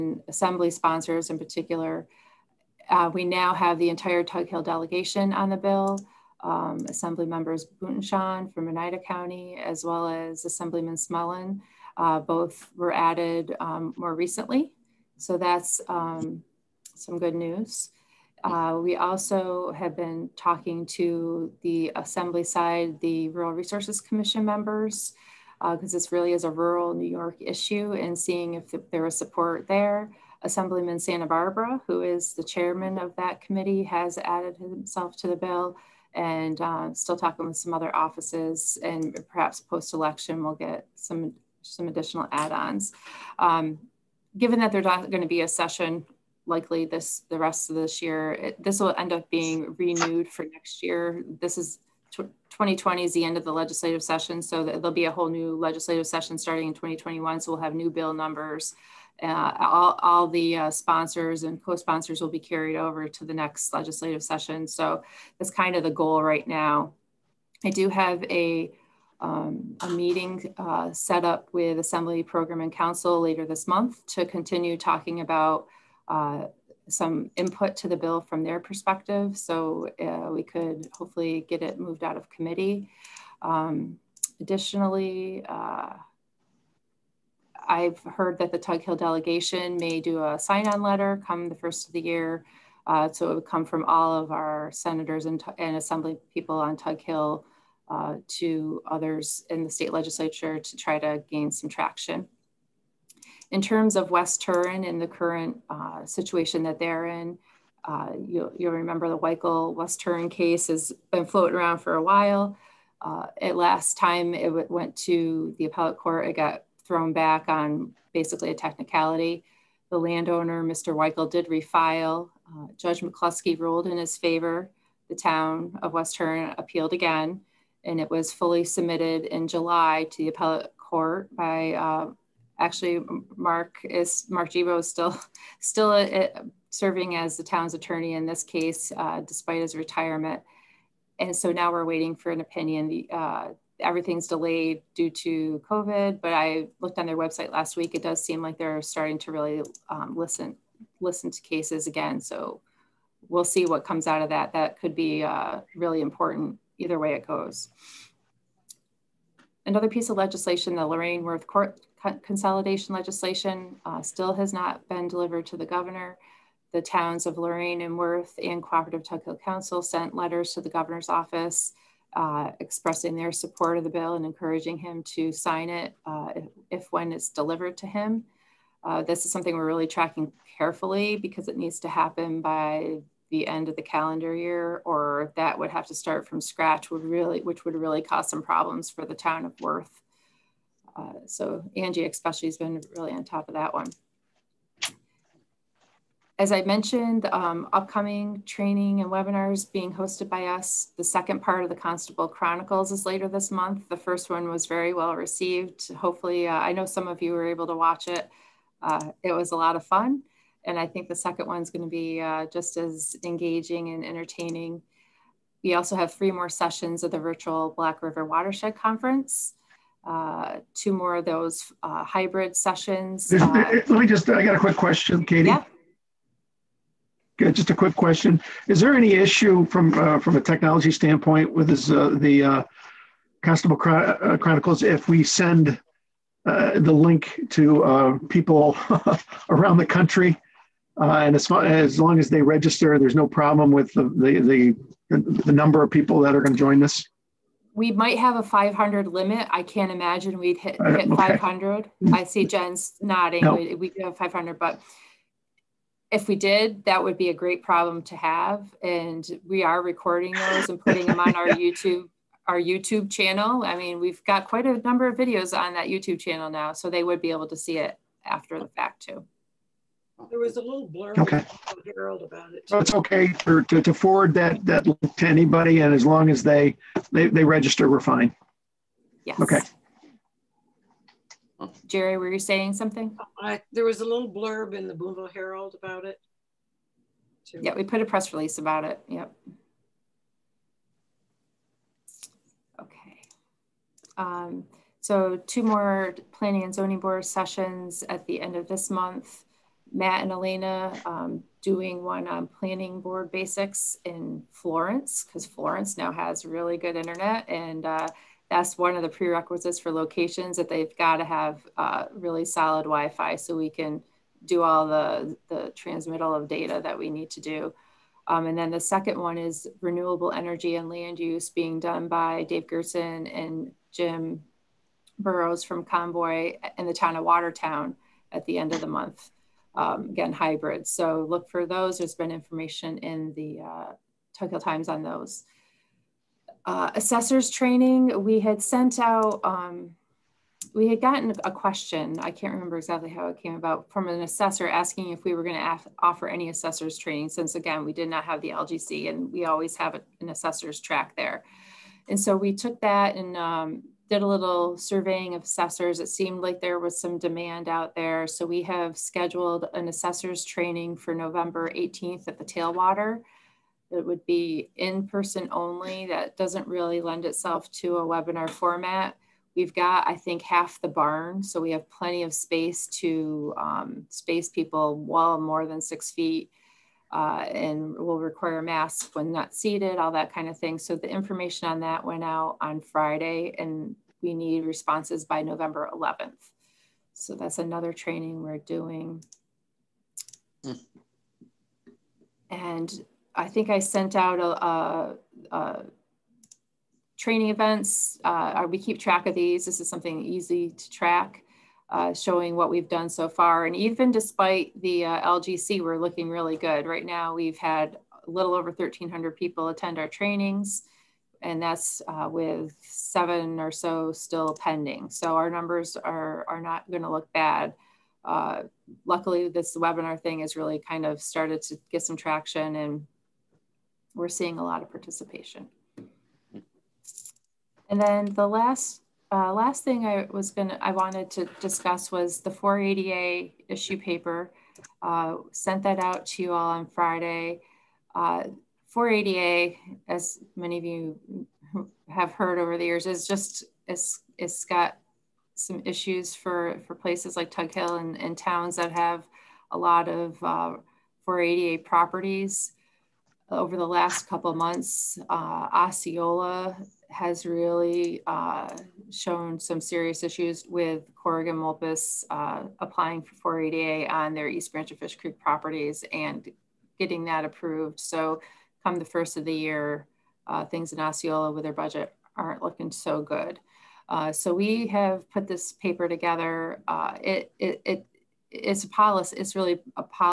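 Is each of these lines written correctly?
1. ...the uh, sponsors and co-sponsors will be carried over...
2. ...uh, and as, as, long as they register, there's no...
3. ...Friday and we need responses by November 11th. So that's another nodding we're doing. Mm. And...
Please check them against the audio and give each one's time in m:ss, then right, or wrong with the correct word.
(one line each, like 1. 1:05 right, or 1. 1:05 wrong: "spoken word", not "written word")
1. 1:00 right
2. 4:01 right
3. 6:22 wrong: "training", not "nodding".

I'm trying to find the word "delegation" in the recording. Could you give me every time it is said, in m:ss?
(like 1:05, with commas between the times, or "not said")
0:04, 1:28.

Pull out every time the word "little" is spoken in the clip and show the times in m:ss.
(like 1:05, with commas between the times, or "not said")
4:30, 4:44, 5:54, 6:48.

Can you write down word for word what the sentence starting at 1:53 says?
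Uh, at last time it went to the appellate court, it got thrown back on basically a technicality.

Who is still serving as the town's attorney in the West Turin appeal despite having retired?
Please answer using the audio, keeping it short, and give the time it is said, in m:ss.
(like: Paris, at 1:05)
Mark Gebo, at 2:14.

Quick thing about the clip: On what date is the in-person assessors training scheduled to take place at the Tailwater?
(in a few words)
November 18th.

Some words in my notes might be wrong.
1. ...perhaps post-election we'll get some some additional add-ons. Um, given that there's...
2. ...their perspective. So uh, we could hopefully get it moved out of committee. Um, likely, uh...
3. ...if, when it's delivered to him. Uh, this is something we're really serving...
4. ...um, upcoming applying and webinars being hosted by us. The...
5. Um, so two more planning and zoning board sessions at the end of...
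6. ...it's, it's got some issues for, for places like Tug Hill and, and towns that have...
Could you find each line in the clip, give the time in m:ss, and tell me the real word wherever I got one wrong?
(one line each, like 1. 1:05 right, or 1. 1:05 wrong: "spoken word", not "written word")
1. 0:39 right
2. 1:18 wrong: "additionally", not "likely"
3. 2:56 wrong: "tracking", not "serving"
4. 3:17 wrong: "training", not "applying"
5. 4:54 right
6. 7:23 right.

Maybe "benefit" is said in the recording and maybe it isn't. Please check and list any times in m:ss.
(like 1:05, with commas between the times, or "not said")
not said.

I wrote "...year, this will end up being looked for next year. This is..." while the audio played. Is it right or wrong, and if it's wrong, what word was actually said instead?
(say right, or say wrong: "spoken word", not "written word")
wrong: "renewed", not "looked".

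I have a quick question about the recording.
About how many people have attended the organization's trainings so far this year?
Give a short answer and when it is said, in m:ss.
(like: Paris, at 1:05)
1,300, at 6:48.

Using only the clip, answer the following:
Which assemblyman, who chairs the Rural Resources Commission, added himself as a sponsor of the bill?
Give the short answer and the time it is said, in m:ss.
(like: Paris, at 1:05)
Santabarbara, at 0:30.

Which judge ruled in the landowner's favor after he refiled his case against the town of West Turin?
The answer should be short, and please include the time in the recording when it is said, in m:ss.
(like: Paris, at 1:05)
Judge McCluskey, at 2:02.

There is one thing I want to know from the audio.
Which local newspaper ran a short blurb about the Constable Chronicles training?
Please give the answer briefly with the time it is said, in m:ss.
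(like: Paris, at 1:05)
Boonville Herald, at 4:44.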